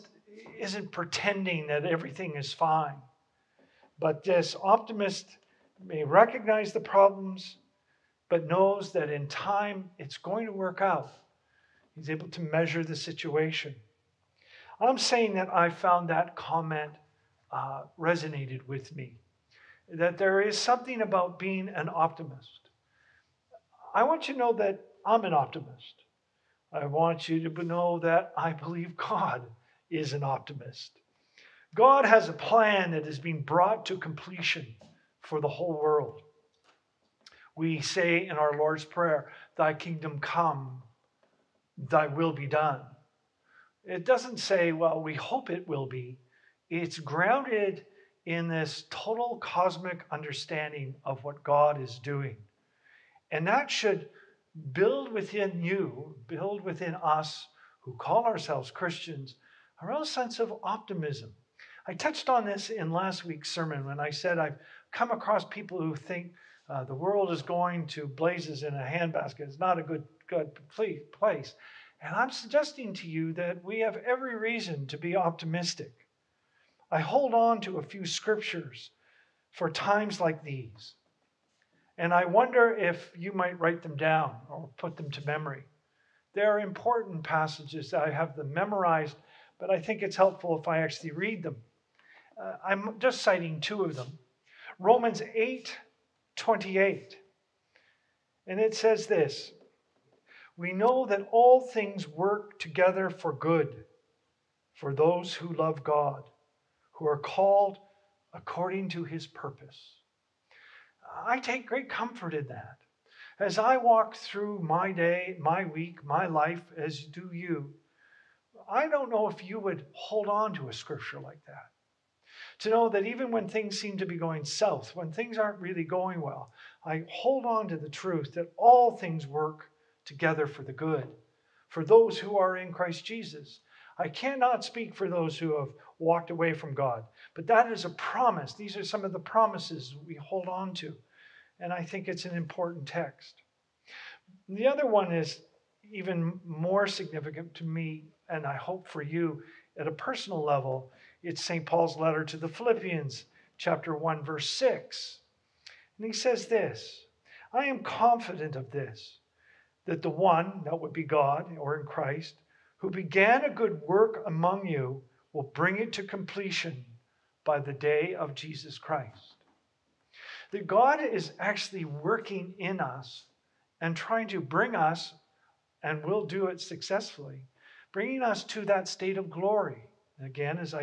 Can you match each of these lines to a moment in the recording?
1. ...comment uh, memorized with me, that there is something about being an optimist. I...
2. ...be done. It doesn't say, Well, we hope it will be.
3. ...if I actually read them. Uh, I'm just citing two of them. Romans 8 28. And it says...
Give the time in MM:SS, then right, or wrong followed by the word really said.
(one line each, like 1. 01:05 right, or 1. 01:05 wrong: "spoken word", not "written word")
1. 00:16 wrong: "resonated", not "memorized"
2. 00:42 right
3. 01:30 right.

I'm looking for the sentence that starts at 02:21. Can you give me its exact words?
And I think it's an important text.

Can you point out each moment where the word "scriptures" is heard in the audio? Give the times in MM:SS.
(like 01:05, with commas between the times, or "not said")
01:18, 02:00.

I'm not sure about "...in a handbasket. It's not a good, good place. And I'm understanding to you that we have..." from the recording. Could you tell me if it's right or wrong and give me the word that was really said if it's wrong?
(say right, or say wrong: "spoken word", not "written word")
wrong: "suggesting", not "understanding".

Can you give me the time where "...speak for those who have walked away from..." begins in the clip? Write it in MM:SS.
02:14.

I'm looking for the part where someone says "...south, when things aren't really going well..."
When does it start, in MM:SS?
02:04.